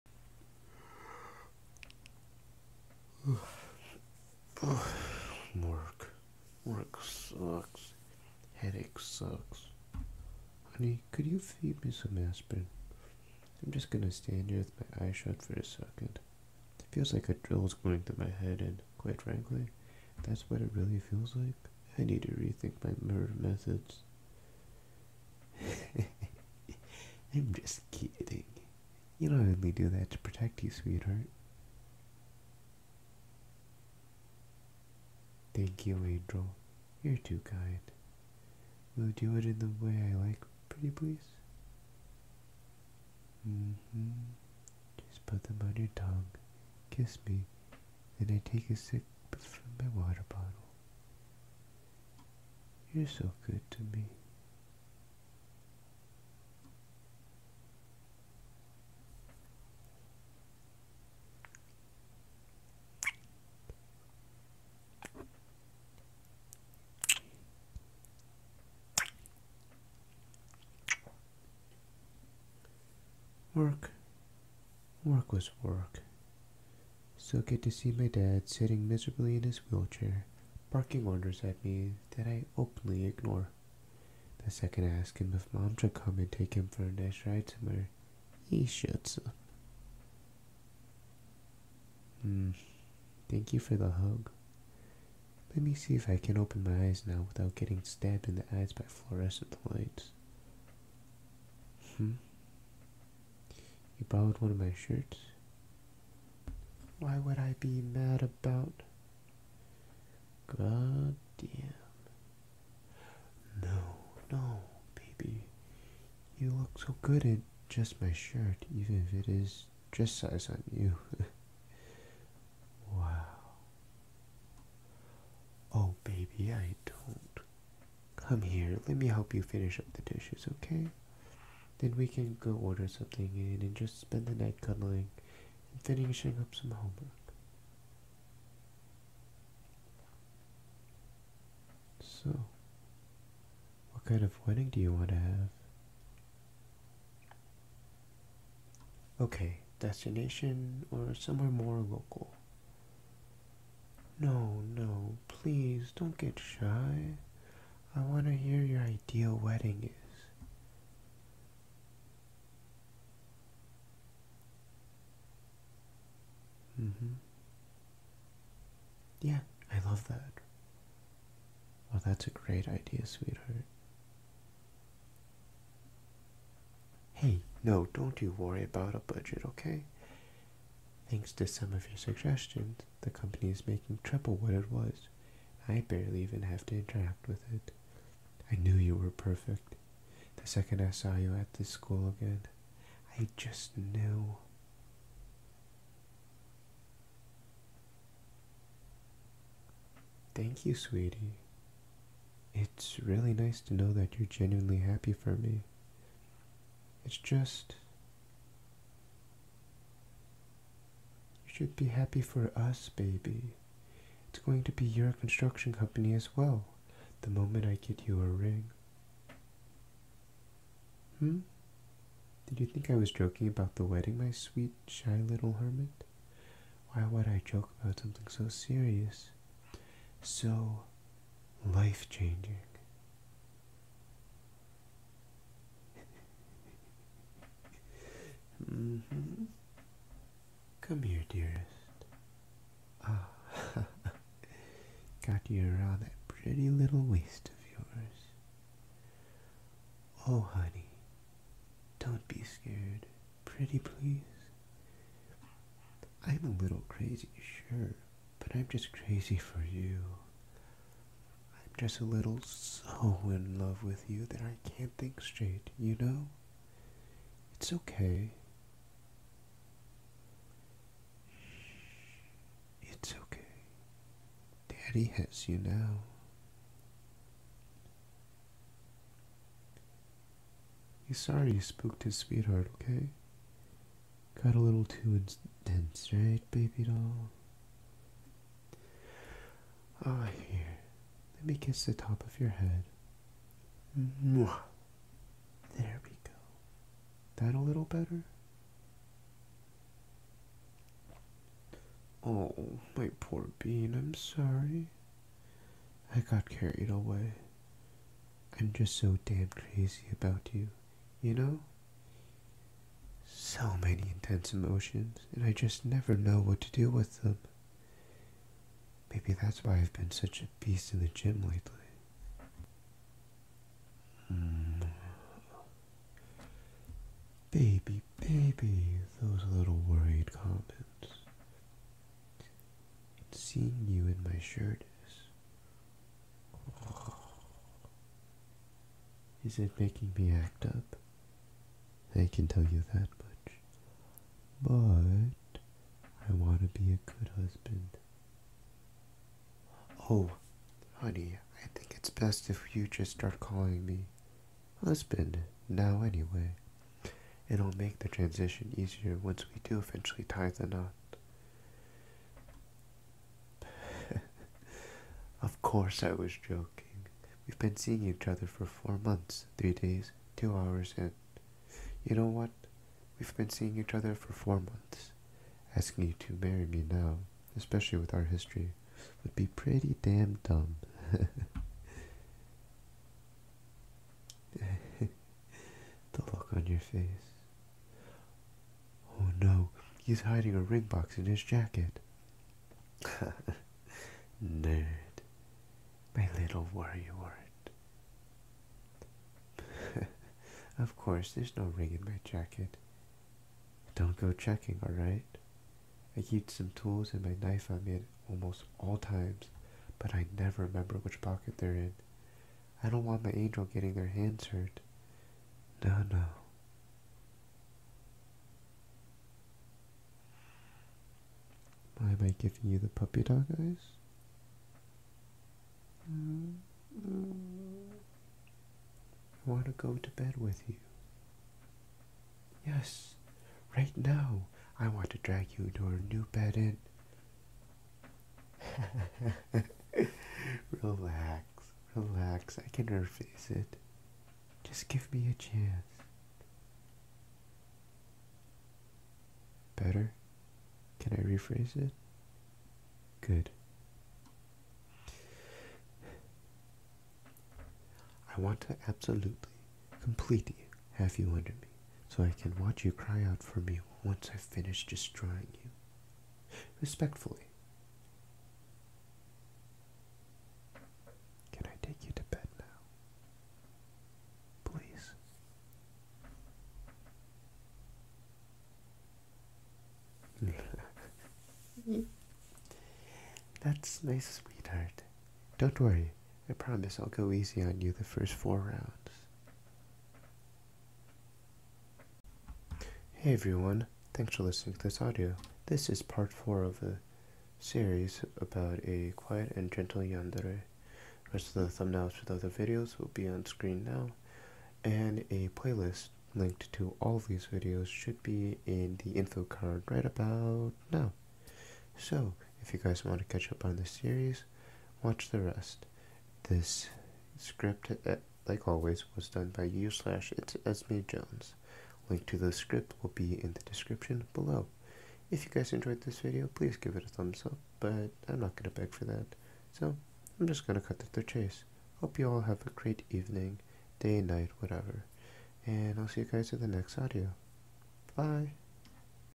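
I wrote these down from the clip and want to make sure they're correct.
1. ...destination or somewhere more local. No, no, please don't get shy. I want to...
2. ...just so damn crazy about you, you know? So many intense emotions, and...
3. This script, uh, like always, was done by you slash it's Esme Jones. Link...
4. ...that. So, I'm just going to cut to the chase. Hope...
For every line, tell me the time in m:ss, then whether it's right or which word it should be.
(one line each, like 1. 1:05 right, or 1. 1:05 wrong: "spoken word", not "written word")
1. 2:29 right
2. 5:08 right
3. 8:36 right
4. 8:49 right.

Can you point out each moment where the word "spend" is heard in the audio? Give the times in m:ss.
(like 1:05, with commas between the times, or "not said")
2:13.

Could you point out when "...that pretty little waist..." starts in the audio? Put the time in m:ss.
4:06.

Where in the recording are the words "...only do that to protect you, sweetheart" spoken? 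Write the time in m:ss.
0:29.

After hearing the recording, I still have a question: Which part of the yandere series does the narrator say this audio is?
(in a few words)
part 4.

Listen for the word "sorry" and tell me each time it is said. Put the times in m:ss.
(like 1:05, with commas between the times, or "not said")
4:41, 5:04.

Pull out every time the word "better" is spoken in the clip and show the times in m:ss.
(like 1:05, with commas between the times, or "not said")
4:57, 7:29.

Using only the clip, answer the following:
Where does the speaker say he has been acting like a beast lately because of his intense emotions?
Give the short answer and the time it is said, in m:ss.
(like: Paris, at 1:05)
the gym, at 5:21.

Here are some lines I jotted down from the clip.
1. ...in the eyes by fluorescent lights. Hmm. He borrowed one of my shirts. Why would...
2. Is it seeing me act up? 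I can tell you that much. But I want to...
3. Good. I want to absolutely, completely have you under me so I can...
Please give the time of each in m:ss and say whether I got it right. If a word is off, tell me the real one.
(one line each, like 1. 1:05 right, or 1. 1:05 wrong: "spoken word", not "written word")
1. 1:38 right
2. 5:39 wrong: "making", not "seeing"
3. 7:33 right.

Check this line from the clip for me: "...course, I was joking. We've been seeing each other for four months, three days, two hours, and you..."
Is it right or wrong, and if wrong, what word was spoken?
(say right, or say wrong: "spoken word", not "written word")
right.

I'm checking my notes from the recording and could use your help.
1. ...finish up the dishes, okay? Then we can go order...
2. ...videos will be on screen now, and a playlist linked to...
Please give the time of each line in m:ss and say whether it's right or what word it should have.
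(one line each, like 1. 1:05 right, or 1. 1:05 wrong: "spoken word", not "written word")
1. 2:09 right
2. 8:22 right.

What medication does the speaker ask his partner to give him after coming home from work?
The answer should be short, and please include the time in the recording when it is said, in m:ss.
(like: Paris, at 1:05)
aspirin, at 0:12.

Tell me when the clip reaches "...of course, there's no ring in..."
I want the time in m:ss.
6:40.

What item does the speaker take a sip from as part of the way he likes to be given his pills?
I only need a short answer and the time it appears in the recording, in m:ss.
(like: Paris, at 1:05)
water bottle, at 0:50.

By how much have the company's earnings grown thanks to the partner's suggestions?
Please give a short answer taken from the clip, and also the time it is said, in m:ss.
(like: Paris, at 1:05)
triple, at 3:04.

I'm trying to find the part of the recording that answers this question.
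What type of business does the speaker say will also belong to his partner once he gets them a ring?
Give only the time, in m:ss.
3:35.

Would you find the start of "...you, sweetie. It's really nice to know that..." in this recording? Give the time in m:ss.
3:20.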